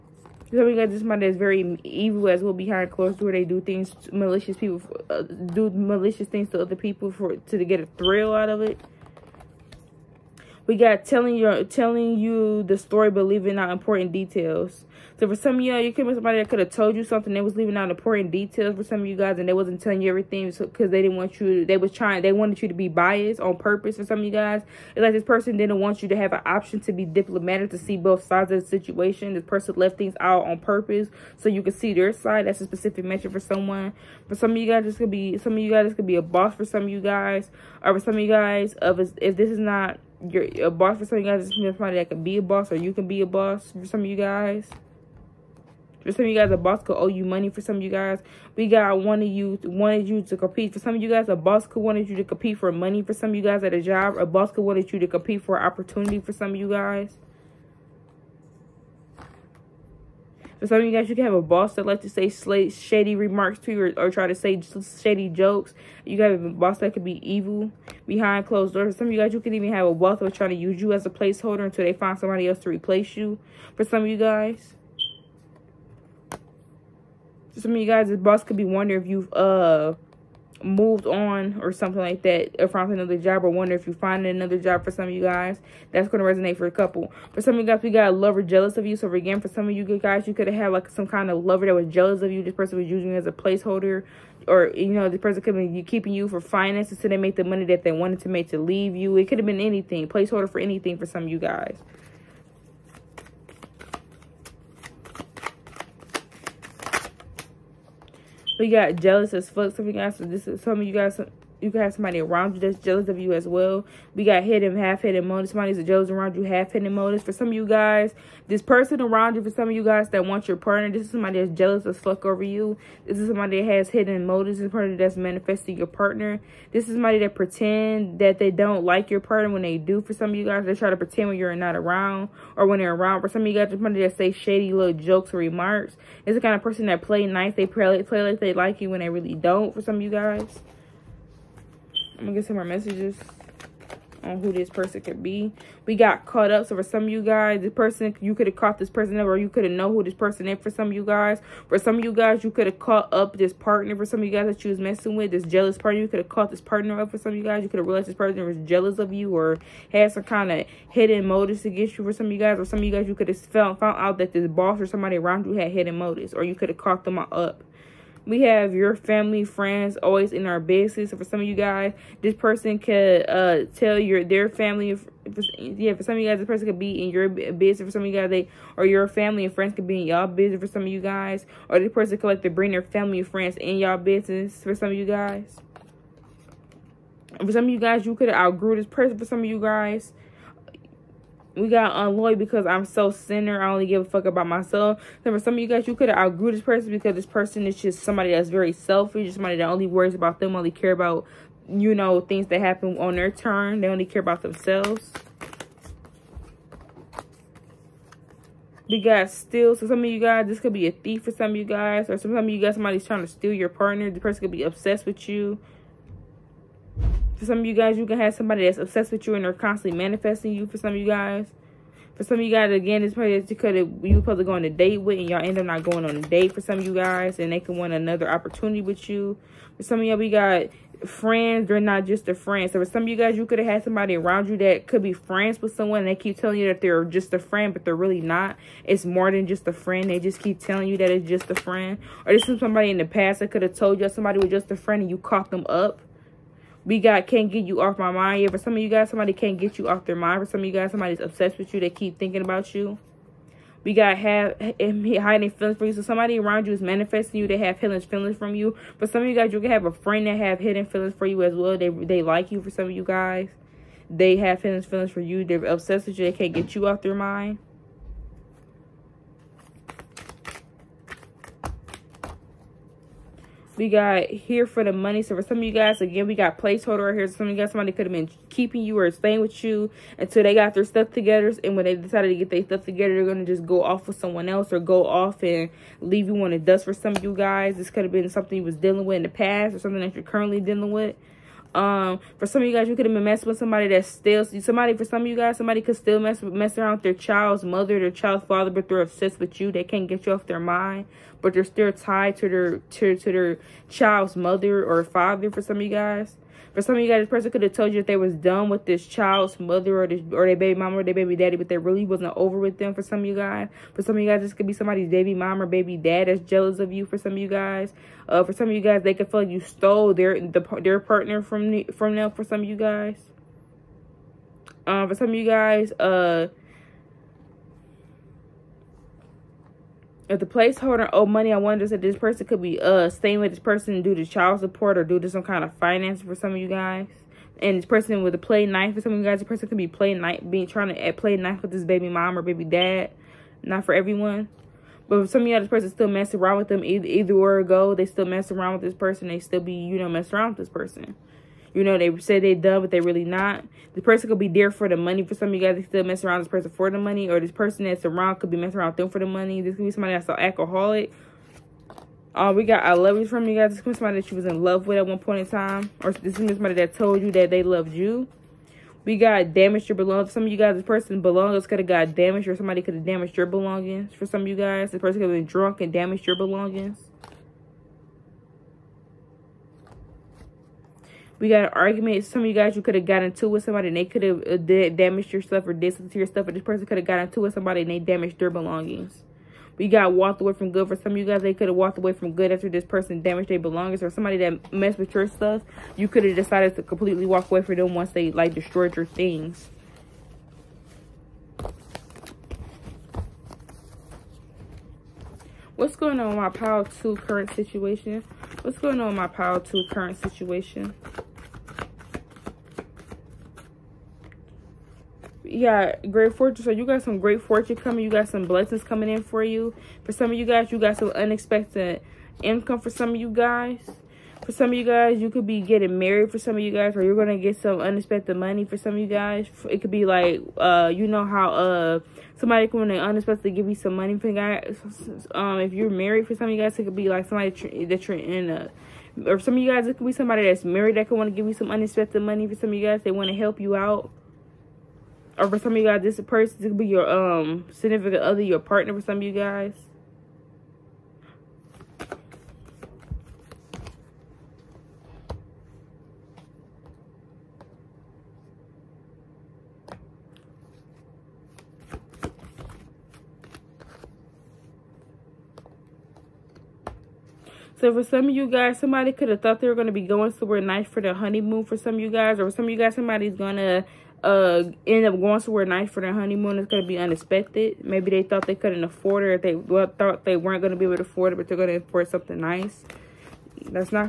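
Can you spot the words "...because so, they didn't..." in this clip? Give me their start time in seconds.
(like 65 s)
20 s.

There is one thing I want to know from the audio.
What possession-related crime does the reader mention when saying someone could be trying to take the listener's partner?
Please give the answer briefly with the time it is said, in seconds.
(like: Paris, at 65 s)
thief, at 210 s.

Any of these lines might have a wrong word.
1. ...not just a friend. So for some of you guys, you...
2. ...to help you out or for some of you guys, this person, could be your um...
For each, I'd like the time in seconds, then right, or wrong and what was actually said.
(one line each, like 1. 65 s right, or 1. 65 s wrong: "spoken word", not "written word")
1. 231 s right
2. 443 s right.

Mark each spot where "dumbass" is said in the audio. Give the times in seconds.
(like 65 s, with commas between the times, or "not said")
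not said.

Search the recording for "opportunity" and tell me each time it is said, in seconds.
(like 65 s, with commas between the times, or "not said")
55 s, 228 s.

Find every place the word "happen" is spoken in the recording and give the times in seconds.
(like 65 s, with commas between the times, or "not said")
202 s.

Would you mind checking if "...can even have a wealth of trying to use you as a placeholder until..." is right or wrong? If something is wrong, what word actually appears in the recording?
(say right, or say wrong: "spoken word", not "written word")
right.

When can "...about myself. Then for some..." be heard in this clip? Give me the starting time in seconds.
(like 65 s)
194 s.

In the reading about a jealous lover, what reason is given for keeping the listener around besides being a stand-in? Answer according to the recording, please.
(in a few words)
finances.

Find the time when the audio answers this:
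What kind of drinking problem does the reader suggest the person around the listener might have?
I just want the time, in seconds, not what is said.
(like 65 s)
360 s.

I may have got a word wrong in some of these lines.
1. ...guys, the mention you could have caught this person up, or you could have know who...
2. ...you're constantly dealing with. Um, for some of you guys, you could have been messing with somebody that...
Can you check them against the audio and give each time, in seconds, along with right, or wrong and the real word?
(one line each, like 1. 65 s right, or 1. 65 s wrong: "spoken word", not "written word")
1. 147 s wrong: "person", not "mention"
2. 290 s wrong: "currently", not "constantly".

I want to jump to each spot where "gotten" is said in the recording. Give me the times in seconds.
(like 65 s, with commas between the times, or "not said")
383 s, 387 s.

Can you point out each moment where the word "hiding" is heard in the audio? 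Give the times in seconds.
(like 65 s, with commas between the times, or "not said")
254 s.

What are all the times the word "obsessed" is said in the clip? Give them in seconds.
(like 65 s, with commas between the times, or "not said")
214 s, 218 s, 251 s, 265 s, 298 s.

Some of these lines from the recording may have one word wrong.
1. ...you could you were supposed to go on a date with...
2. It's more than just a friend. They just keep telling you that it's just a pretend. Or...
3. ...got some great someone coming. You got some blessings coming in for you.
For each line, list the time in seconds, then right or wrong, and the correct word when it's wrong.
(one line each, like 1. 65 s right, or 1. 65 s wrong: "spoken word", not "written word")
1. 223 s right
2. 238 s wrong: "friend", not "pretend"
3. 416 s wrong: "fortune", not "someone".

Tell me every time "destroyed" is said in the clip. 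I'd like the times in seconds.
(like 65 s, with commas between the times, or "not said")
398 s.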